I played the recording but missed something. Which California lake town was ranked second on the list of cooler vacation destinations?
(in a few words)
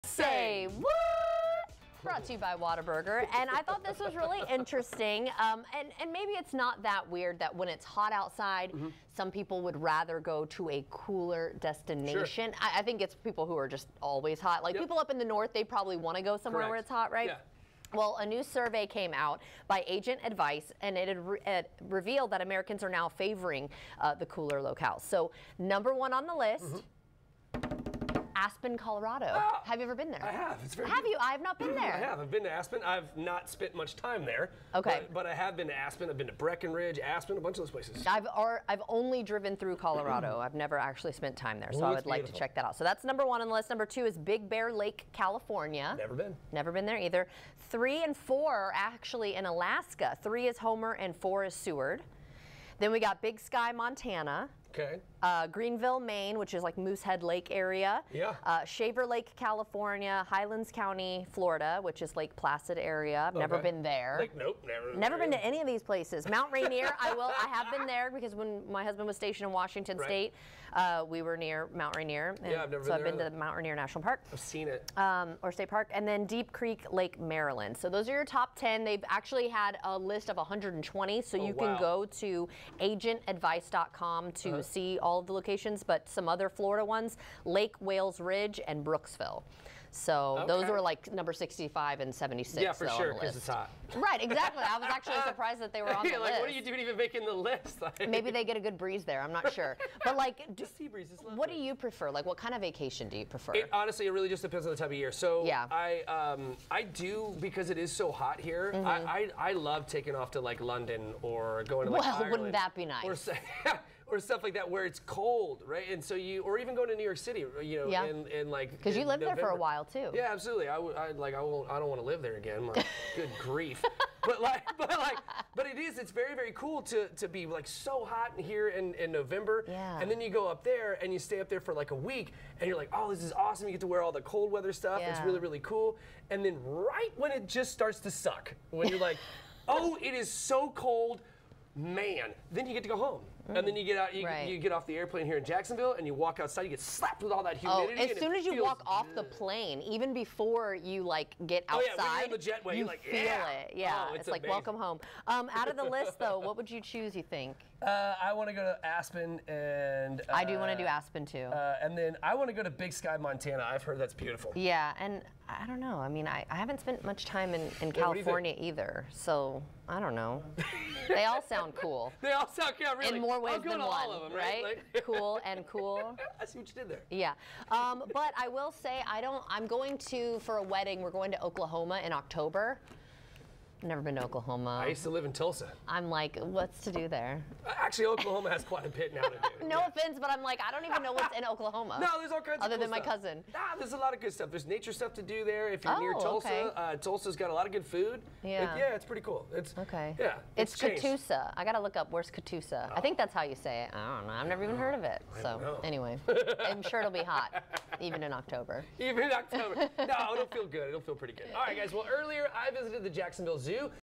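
Big Bear Lake.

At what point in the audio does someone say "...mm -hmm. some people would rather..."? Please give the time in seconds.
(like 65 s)
8 s.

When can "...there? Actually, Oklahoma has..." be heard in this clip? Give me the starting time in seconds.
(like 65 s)
187 s.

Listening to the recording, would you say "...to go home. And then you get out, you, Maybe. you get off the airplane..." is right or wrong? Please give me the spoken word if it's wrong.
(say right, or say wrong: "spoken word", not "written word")
wrong: "Right", not "Maybe".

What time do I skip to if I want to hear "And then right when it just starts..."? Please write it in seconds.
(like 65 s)
136 s.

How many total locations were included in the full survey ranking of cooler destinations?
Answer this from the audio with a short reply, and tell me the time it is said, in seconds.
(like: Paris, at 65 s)
120, at 80 s.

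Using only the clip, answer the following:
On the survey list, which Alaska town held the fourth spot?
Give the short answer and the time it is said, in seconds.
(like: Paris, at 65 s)
Seward, at 51 s.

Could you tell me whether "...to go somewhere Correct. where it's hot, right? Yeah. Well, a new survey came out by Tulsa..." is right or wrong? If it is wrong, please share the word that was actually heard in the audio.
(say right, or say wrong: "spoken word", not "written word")
wrong: "Agent", not "Tulsa".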